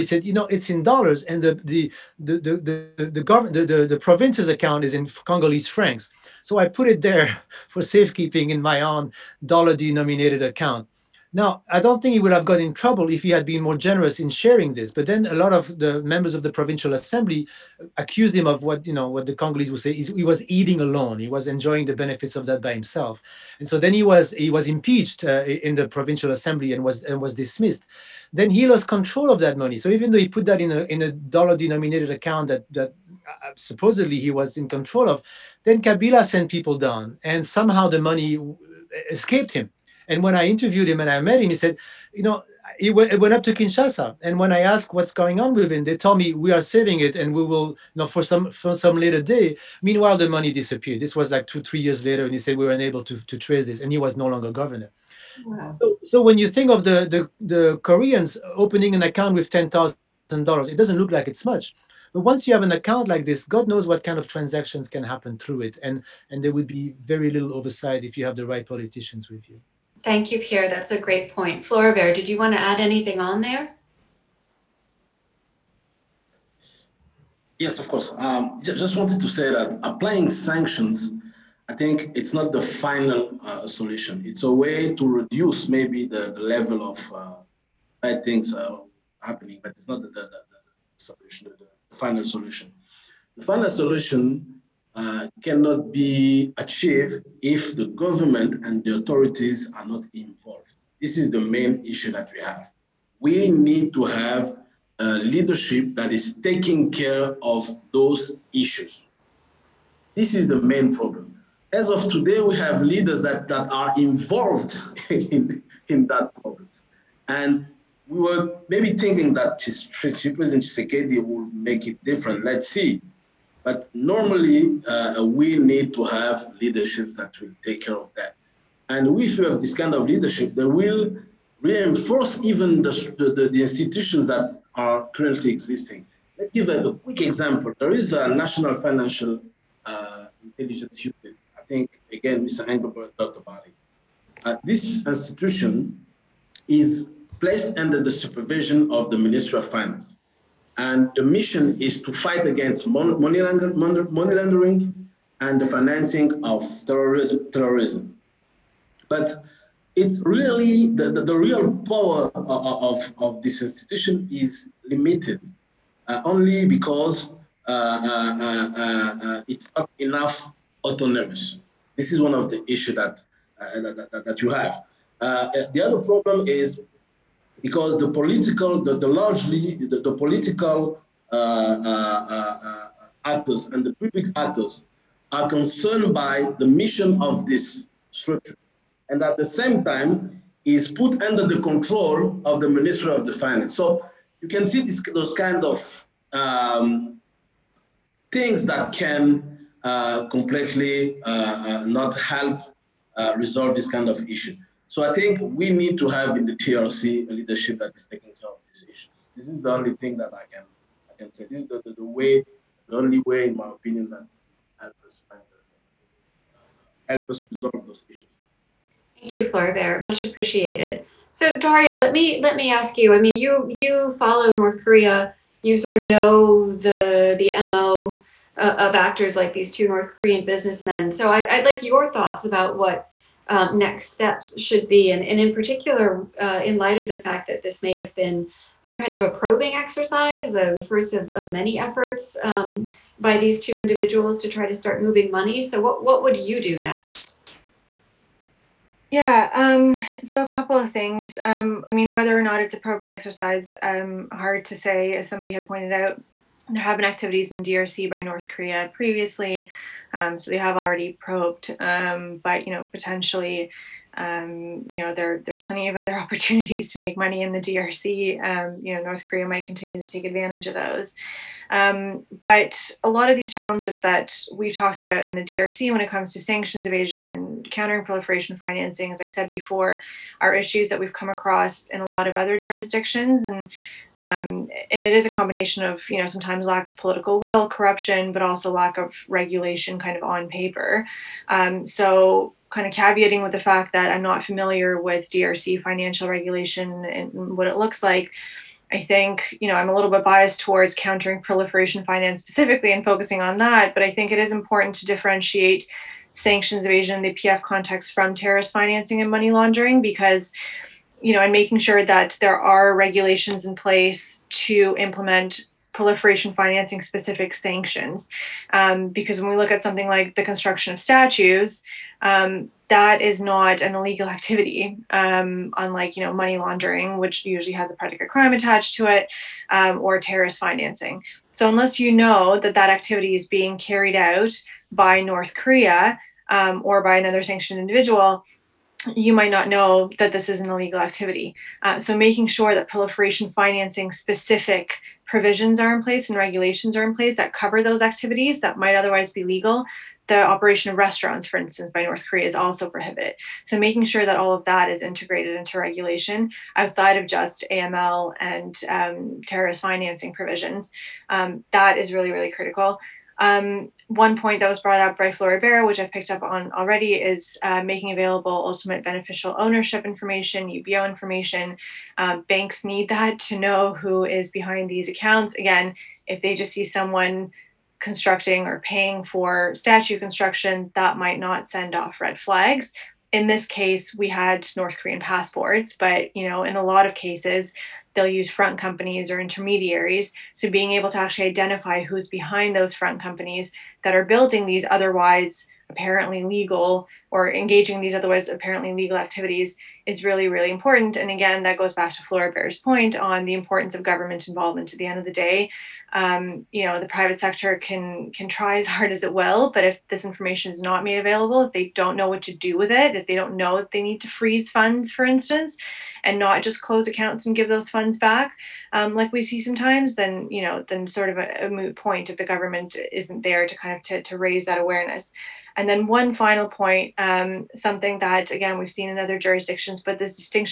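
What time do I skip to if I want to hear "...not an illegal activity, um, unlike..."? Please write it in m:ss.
5:23.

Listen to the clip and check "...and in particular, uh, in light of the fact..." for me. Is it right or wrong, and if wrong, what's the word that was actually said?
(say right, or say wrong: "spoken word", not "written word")
right.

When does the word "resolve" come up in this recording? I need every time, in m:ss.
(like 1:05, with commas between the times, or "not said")
3:23, 3:37.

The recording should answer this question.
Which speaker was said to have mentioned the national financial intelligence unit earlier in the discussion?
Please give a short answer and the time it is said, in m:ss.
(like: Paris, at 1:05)
Mr. Englebert, at 2:22.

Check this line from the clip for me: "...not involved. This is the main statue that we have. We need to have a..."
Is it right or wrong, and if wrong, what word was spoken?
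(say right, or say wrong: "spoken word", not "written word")
wrong: "issue", not "statue".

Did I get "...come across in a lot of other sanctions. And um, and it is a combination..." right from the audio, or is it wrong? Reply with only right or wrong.
wrong.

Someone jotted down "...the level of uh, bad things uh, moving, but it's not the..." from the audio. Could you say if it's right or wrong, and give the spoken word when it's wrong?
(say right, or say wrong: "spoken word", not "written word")
wrong: "happening", not "moving".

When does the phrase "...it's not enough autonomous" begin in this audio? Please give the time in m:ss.
2:49.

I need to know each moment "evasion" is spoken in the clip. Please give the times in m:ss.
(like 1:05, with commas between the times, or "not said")
4:36, 5:06.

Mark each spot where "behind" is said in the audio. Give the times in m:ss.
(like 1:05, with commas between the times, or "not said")
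6:14, 6:32.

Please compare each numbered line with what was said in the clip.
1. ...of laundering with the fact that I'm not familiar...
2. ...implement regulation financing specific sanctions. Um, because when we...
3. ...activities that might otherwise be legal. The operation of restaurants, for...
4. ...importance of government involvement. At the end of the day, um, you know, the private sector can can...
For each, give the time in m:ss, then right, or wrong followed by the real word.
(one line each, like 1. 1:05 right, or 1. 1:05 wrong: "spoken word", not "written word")
1. 4:52 wrong: "caveating", not "laundering"
2. 5:14 wrong: "proliferation", not "regulation"
3. 5:48 right
4. 6:43 right.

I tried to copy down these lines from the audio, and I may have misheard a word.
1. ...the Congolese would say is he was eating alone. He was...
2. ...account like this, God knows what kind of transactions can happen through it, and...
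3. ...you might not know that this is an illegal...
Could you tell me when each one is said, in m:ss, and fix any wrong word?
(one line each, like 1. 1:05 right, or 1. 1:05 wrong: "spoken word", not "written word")
1. 0:19 right
2. 1:02 right
3. 5:39 right.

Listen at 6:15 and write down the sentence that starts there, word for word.
Again, if they just see someone constructing or paying for statue construction, that might not send off red flags.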